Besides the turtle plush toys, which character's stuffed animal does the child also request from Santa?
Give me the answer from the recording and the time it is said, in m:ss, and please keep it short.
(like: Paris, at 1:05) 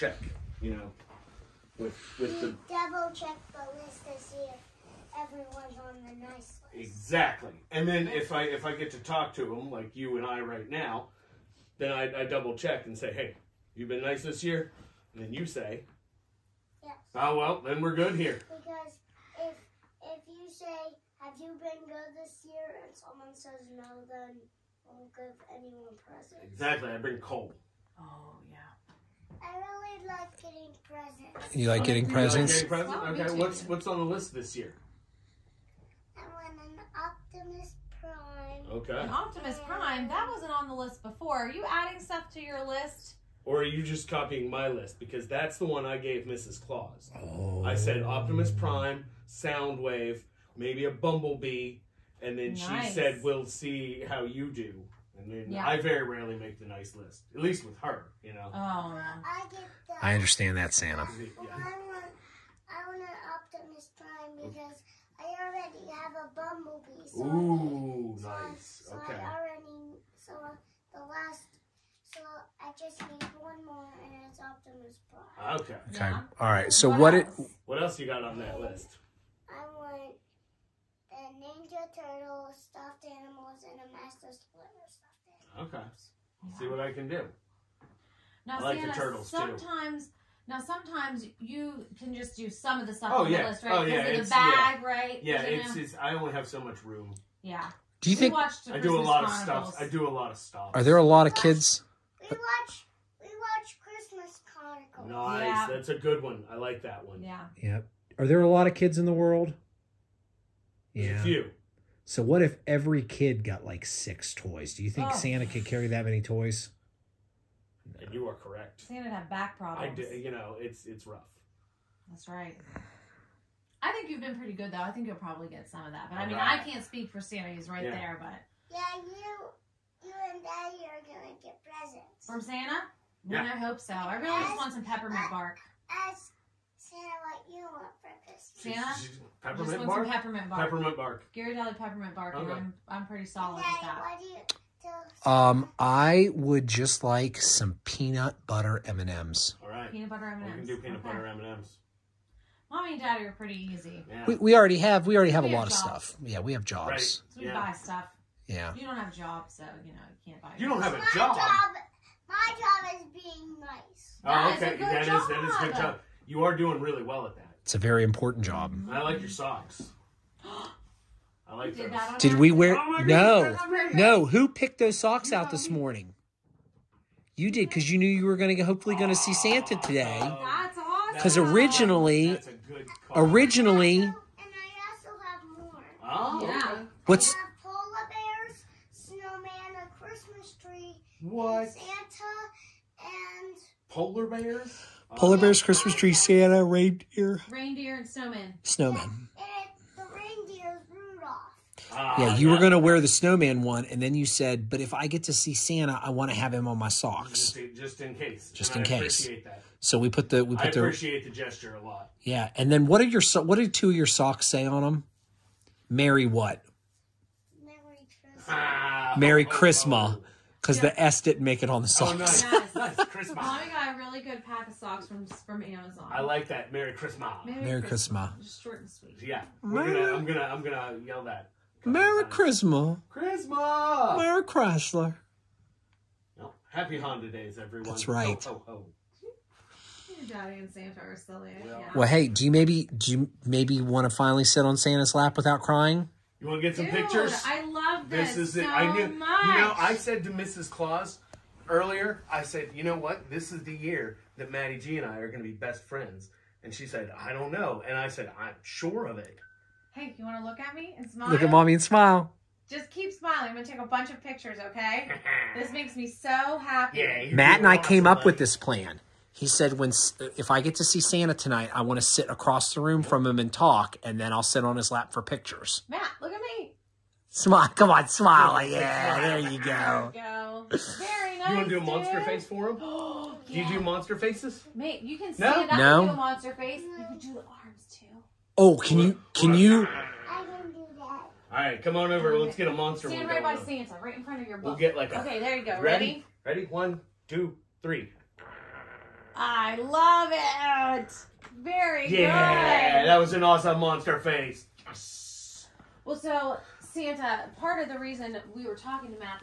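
Master Splinter, at 1:23.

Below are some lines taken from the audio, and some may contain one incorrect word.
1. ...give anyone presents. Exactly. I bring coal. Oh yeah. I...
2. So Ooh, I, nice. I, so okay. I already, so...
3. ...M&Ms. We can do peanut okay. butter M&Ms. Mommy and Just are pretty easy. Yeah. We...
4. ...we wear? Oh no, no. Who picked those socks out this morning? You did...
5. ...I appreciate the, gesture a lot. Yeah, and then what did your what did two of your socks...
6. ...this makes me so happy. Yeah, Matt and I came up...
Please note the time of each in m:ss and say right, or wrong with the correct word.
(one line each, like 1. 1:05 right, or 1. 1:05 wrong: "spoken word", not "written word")
1. 0:25 right
2. 1:07 right
3. 2:30 wrong: "Daddy", not "Just"
4. 2:52 right
5. 3:30 right
6. 4:25 right.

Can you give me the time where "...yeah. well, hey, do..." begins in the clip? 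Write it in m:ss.
4:01.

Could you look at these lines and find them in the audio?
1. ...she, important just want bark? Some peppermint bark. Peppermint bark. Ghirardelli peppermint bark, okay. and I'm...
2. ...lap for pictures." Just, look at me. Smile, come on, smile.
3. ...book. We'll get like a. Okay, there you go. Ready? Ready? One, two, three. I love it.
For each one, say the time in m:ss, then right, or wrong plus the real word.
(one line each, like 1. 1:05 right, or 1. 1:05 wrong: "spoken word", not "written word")
1. 2:19 wrong: "peppermint", not "important"
2. 4:34 wrong: "Matt", not "Just"
3. 4:54 right.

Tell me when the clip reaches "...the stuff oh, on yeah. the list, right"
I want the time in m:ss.
1:32.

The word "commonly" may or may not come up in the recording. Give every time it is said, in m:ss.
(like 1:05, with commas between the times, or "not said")
not said.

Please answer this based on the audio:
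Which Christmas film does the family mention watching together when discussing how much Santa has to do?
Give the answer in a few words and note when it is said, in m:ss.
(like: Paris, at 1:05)
Christmas Chronicles, at 1:43.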